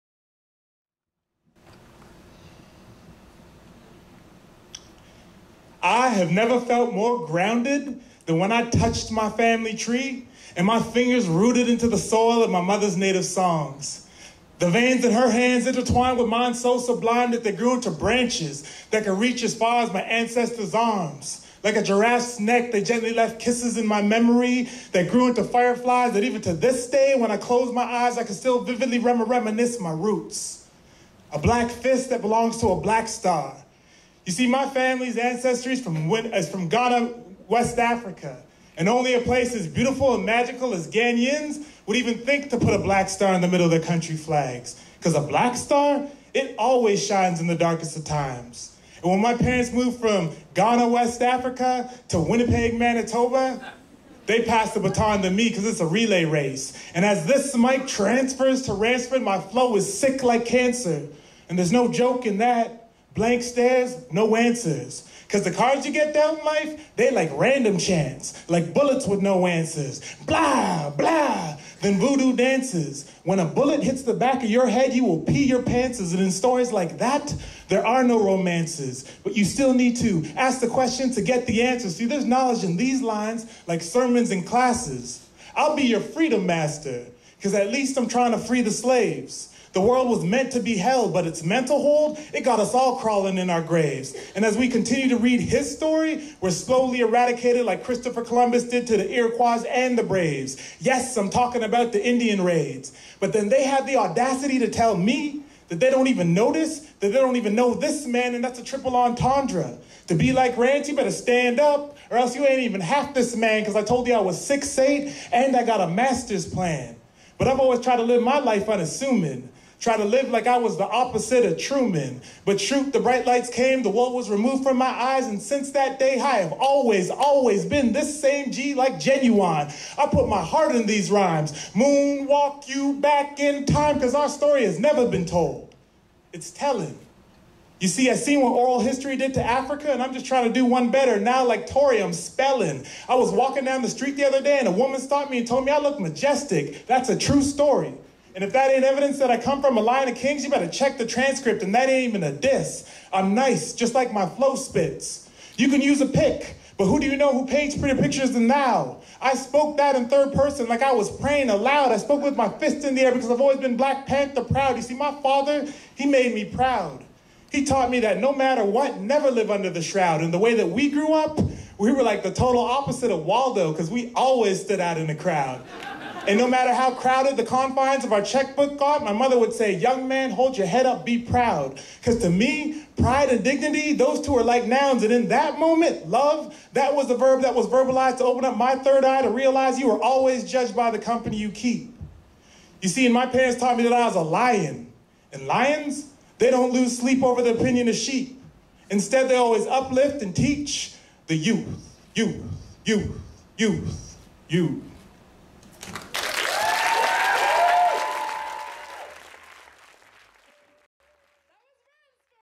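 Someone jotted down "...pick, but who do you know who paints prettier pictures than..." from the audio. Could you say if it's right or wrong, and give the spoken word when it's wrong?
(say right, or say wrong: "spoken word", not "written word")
right.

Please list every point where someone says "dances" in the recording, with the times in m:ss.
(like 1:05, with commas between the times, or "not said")
1:12.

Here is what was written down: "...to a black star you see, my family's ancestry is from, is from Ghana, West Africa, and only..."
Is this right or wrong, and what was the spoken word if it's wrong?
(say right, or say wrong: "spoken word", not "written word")
right.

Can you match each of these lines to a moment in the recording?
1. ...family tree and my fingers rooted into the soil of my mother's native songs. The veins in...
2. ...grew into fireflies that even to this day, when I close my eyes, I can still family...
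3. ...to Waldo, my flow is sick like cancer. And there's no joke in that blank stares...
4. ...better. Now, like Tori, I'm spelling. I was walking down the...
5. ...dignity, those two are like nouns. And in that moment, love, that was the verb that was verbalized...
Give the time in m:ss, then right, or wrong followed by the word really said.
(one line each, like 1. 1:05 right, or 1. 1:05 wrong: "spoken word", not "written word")
1. 0:09 right
2. 0:25 wrong: "vividly", not "family"
3. 0:58 wrong: "Ransford", not "Waldo"
4. 2:20 right
5. 3:03 right.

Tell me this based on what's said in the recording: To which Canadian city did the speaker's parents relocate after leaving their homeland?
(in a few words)
Winnipeg, Manitoba.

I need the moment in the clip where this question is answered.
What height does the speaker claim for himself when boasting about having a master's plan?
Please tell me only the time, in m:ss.
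1:54.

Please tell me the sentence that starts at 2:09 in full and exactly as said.
I put my heart in these rhymes.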